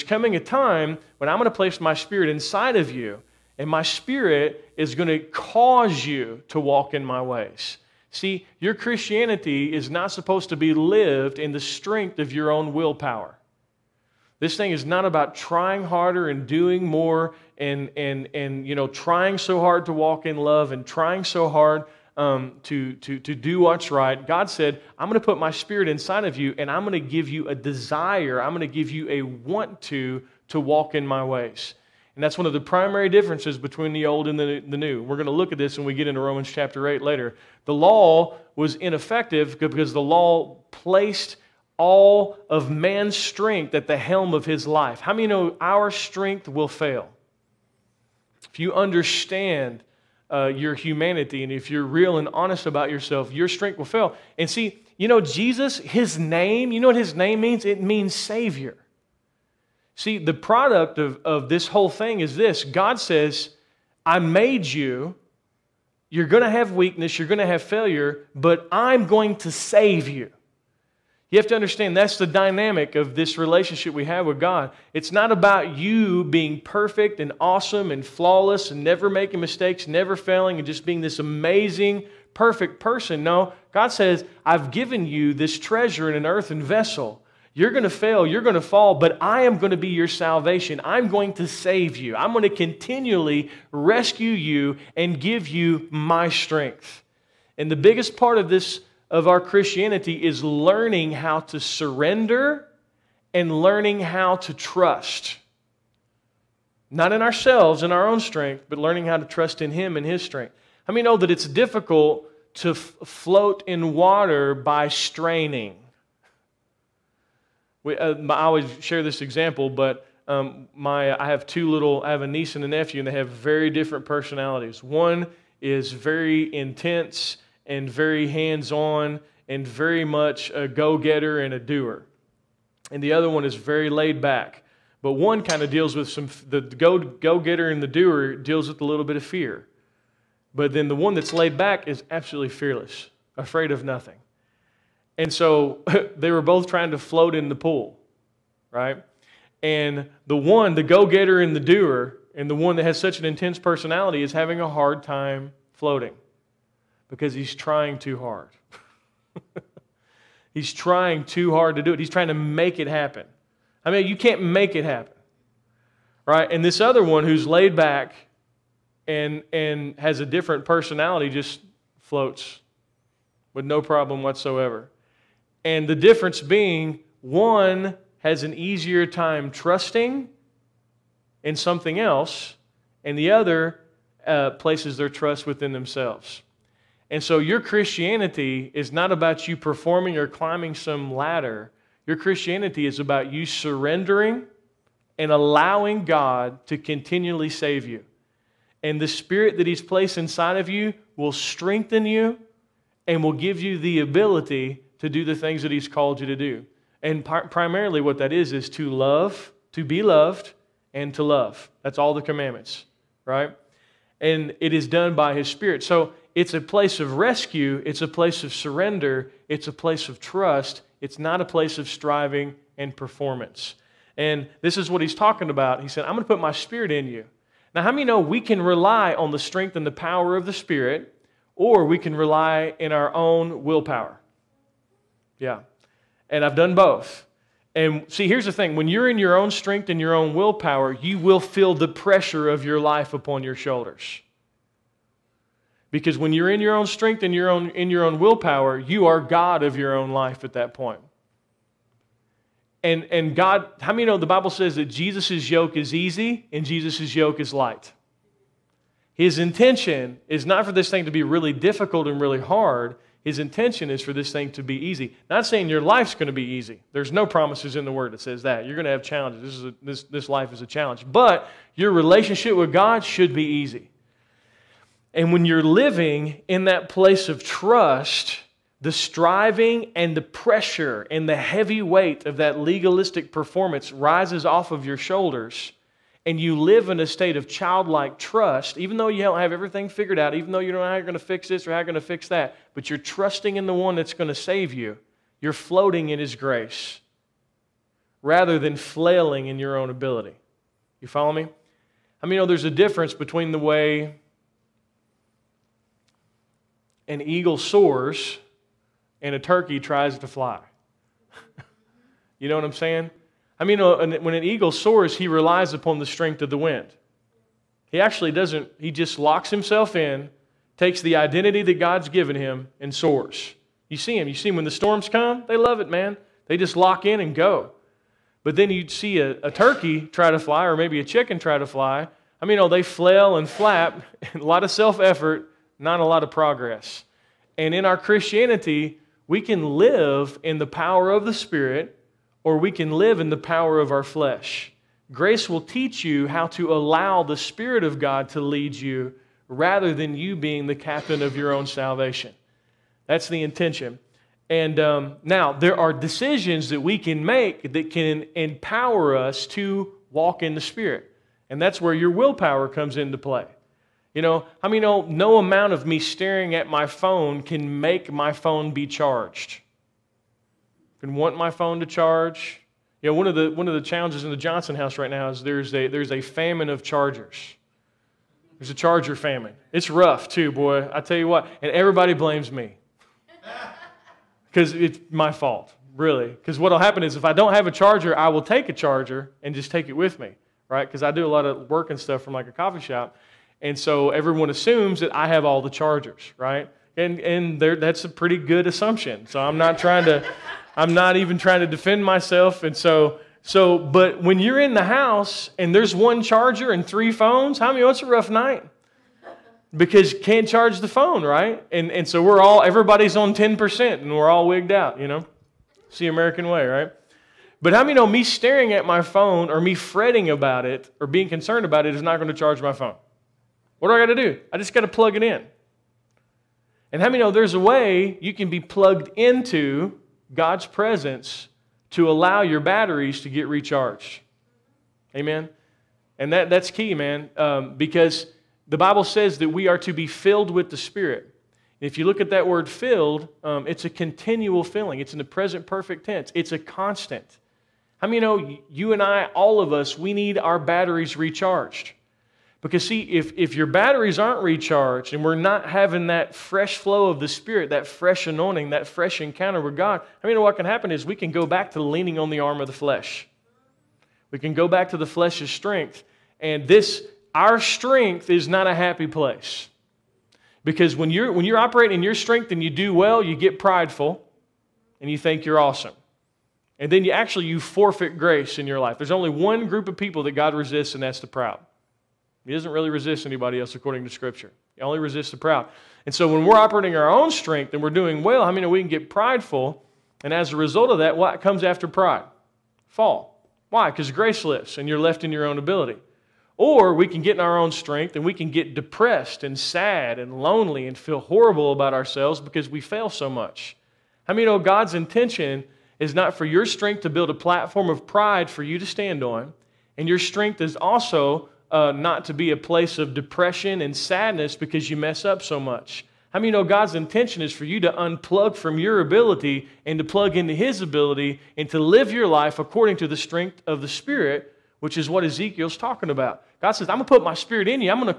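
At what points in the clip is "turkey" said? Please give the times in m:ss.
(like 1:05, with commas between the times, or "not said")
5:09, 5:29.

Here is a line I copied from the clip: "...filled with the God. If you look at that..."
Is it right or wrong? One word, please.
wrong.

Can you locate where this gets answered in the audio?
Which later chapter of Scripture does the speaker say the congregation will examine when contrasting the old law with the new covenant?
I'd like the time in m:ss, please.
0:36.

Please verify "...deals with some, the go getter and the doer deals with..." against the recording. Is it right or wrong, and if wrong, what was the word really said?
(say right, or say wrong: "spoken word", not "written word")
right.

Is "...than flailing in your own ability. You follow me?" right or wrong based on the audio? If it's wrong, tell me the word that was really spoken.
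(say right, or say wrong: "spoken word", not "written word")
right.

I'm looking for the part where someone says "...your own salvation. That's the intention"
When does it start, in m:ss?
5:51.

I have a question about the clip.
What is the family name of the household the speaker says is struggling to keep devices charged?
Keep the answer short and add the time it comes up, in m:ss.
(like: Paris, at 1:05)
Johnson, at 6:14.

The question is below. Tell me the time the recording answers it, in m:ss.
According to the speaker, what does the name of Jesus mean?
0:58.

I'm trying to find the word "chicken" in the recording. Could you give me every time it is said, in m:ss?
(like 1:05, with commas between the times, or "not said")
5:31.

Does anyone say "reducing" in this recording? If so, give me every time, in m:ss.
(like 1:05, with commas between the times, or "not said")
not said.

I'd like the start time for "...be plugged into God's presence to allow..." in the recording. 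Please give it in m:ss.
7:08.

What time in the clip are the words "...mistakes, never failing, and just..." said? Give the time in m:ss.
1:19.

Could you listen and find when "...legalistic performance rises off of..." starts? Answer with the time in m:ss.
4:42.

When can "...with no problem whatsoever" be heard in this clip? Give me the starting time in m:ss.
2:53.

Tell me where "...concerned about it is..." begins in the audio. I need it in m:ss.
7:01.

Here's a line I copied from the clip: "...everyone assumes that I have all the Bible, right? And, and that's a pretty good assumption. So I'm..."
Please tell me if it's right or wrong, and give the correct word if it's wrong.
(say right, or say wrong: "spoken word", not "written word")
wrong: "Chargers", not "Bible".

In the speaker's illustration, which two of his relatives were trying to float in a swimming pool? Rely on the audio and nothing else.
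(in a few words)
A niece and a nephew.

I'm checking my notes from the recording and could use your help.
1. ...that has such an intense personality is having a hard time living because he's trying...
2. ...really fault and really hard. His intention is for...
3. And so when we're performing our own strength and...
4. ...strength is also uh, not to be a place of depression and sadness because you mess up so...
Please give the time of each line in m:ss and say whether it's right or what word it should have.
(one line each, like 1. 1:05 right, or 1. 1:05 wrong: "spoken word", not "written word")
1. 2:32 wrong: "floating", not "living"
2. 4:21 wrong: "difficult", not "fault"
3. 8:06 wrong: "operating", not "performing"
4. 8:30 right.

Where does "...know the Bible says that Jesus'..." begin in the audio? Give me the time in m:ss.
4:14.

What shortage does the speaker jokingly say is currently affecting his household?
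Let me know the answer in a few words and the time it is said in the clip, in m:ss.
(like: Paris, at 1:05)
A charger famine, at 6:18.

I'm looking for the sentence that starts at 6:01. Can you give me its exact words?
And that's where your willpower comes into play.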